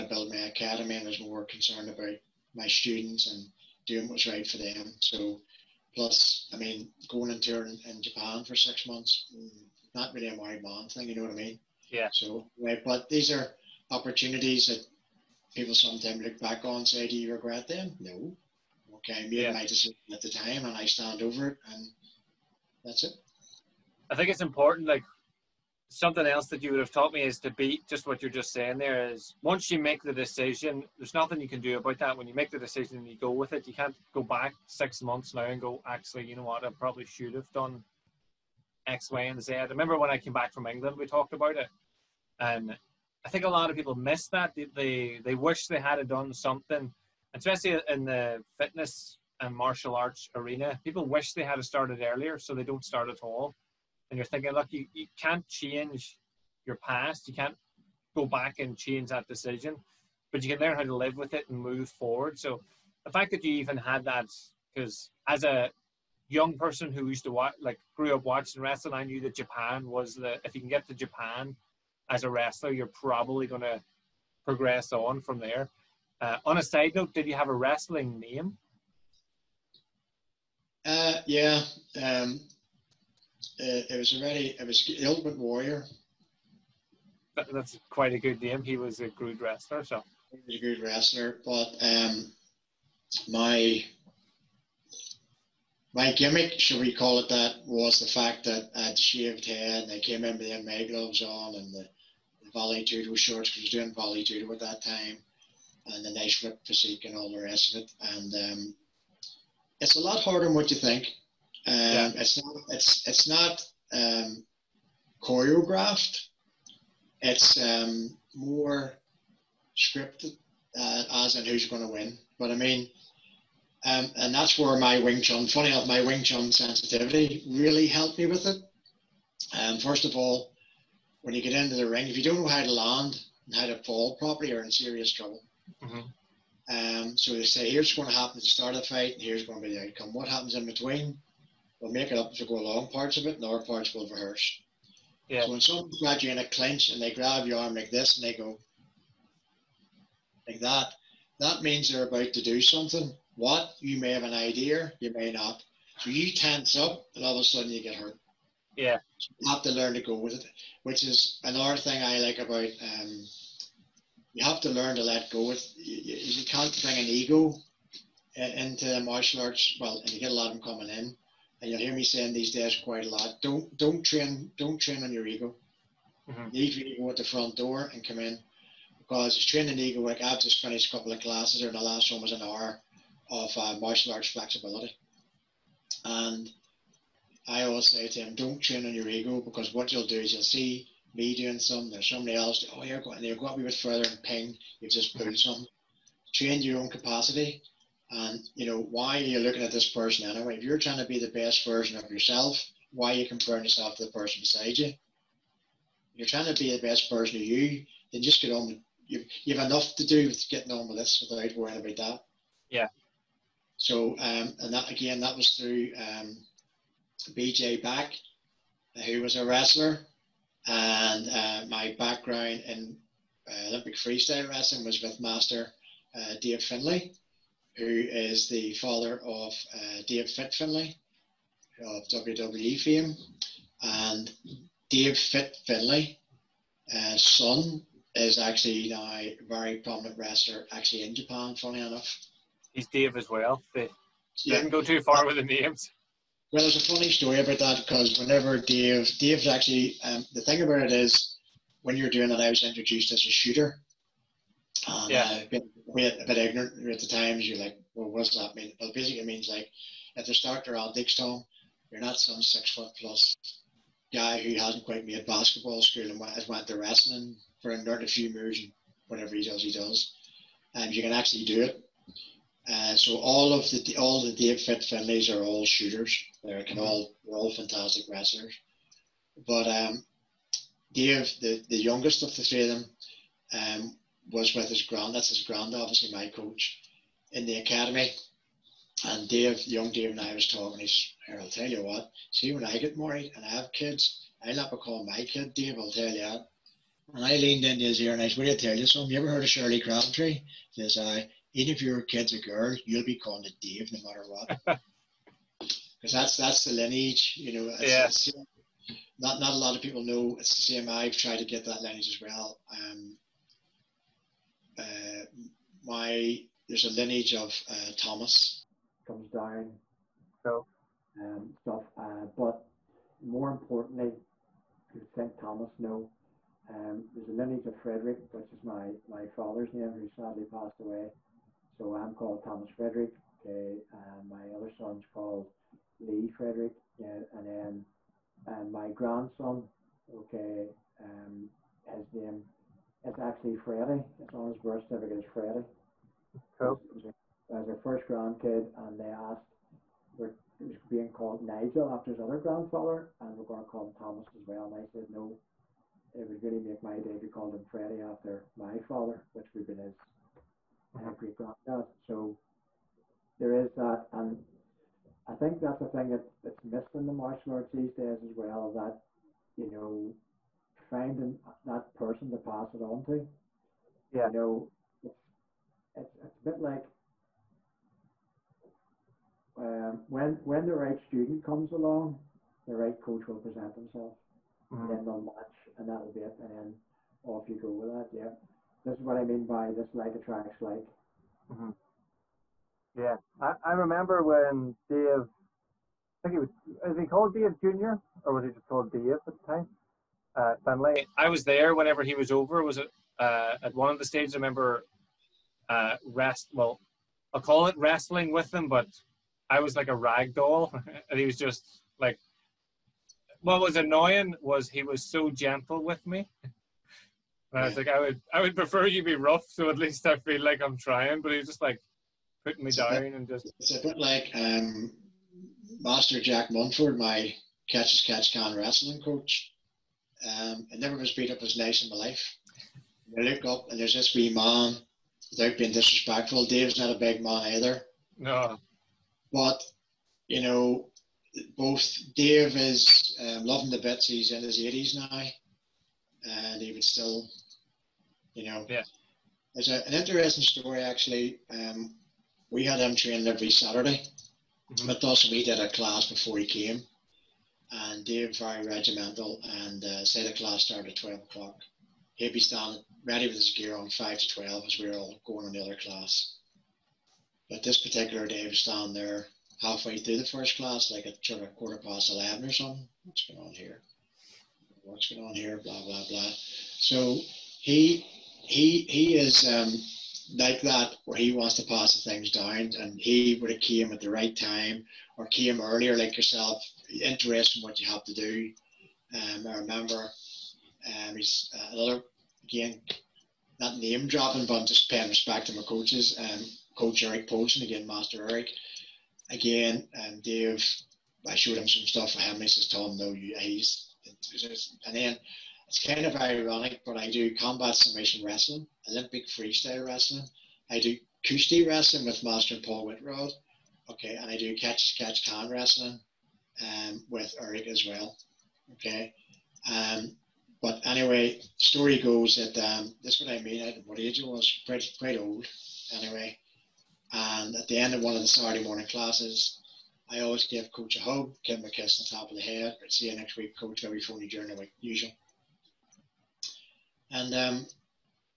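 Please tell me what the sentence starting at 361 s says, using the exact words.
So there is that, and I think that's a thing that, that's missed in the martial arts these days as well.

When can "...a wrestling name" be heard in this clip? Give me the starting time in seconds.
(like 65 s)
77 s.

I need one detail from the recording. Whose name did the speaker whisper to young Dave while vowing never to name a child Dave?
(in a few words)
Shirley Crabtree.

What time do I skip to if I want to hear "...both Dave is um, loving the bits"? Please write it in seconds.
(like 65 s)
441 s.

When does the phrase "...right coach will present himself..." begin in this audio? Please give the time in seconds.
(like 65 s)
382 s.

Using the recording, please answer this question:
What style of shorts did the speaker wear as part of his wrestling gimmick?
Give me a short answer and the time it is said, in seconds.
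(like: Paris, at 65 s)
Vale Tudo shorts, at 102 s.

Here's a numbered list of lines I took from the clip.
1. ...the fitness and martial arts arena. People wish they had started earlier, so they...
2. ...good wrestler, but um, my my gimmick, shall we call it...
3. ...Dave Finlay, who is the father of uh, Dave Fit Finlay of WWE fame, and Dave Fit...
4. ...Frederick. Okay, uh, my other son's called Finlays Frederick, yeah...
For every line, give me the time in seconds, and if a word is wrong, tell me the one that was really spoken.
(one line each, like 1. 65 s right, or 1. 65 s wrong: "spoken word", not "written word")
1. 48 s right
2. 90 s right
3. 226 s right
4. 332 s wrong: "Lee", not "Finlays".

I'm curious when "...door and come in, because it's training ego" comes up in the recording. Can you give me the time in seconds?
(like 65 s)
177 s.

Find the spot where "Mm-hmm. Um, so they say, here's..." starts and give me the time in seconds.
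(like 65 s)
135 s.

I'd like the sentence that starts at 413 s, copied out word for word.
What was annoying was he was so gentle with me.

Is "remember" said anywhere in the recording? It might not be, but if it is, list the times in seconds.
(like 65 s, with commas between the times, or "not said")
39 s, 393 s, 404 s, 489 s.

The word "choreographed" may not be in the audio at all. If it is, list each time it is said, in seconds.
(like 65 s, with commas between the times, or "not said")
115 s.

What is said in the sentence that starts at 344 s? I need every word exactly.
It's on his birth certificate is Freddie.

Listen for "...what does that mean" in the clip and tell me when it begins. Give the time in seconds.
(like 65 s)
258 s.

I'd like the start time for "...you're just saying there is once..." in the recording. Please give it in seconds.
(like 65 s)
28 s.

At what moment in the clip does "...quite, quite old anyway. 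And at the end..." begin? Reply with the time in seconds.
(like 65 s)
524 s.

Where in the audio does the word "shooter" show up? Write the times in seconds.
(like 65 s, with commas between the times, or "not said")
253 s, 275 s.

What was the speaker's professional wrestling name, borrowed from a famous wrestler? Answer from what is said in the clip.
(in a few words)
The Ultimate Warrior.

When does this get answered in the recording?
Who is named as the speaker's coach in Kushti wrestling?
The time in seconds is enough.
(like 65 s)
512 s.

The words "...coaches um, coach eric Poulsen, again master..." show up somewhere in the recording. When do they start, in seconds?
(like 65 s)
495 s.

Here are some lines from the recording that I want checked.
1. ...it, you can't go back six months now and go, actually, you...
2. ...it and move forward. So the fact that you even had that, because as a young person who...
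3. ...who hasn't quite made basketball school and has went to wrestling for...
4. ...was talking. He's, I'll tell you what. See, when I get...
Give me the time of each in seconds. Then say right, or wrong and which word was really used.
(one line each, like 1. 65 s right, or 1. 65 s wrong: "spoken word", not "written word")
1. 33 s right
2. 61 s right
3. 264 s right
4. 290 s right.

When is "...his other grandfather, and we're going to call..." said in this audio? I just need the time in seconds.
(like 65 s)
352 s.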